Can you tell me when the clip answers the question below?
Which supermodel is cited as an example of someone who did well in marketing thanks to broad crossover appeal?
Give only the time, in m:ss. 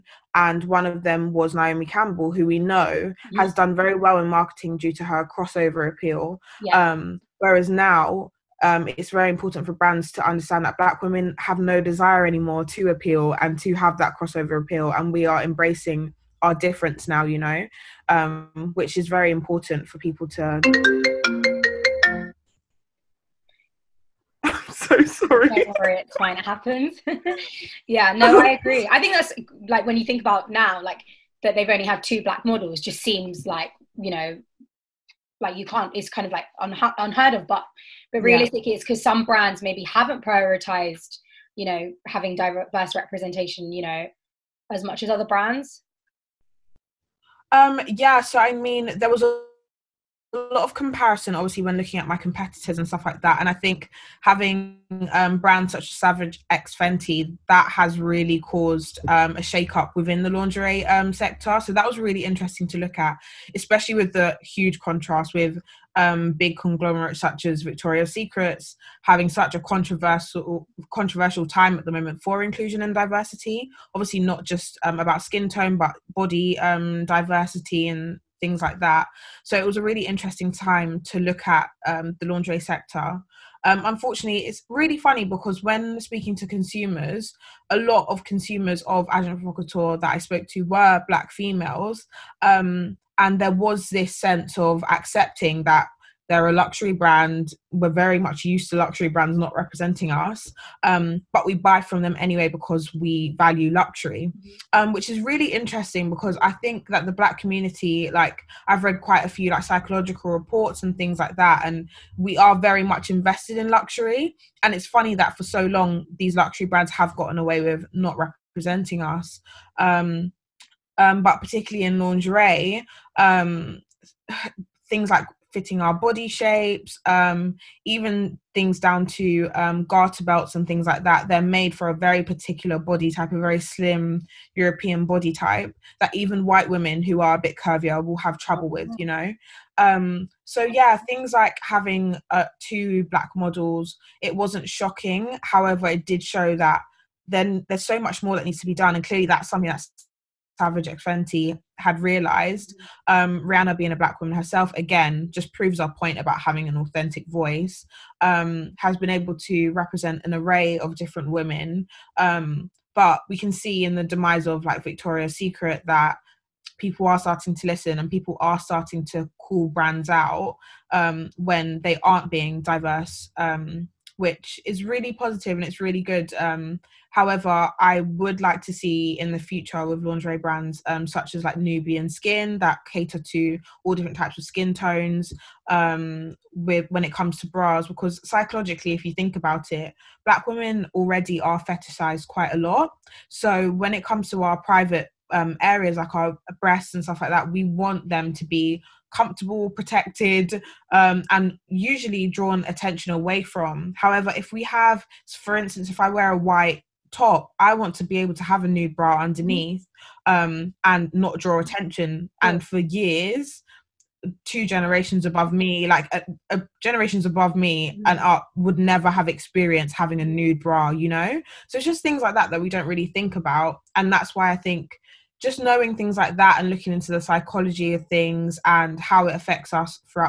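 0:01.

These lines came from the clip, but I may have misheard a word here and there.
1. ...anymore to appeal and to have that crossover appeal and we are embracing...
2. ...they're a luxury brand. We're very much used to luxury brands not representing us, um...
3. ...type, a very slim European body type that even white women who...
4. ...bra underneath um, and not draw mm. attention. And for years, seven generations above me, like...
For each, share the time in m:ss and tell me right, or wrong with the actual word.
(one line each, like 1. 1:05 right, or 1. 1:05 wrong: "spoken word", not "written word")
1. 0:12 right
2. 1:36 right
3. 2:13 right
4. 3:28 wrong: "two", not "seven".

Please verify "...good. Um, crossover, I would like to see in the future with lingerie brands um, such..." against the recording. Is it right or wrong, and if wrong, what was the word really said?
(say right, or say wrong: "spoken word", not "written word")
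wrong: "however", not "crossover".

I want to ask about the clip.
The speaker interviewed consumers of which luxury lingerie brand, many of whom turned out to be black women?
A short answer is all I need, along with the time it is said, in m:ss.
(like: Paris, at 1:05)
Agent Provocateur, at 1:29.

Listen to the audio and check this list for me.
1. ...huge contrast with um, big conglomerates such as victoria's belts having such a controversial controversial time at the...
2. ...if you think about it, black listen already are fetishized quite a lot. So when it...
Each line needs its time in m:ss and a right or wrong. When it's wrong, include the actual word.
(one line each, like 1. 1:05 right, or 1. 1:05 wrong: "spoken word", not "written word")
1. 1:04 wrong: "secrets", not "belts"
2. 3:08 wrong: "women", not "listen".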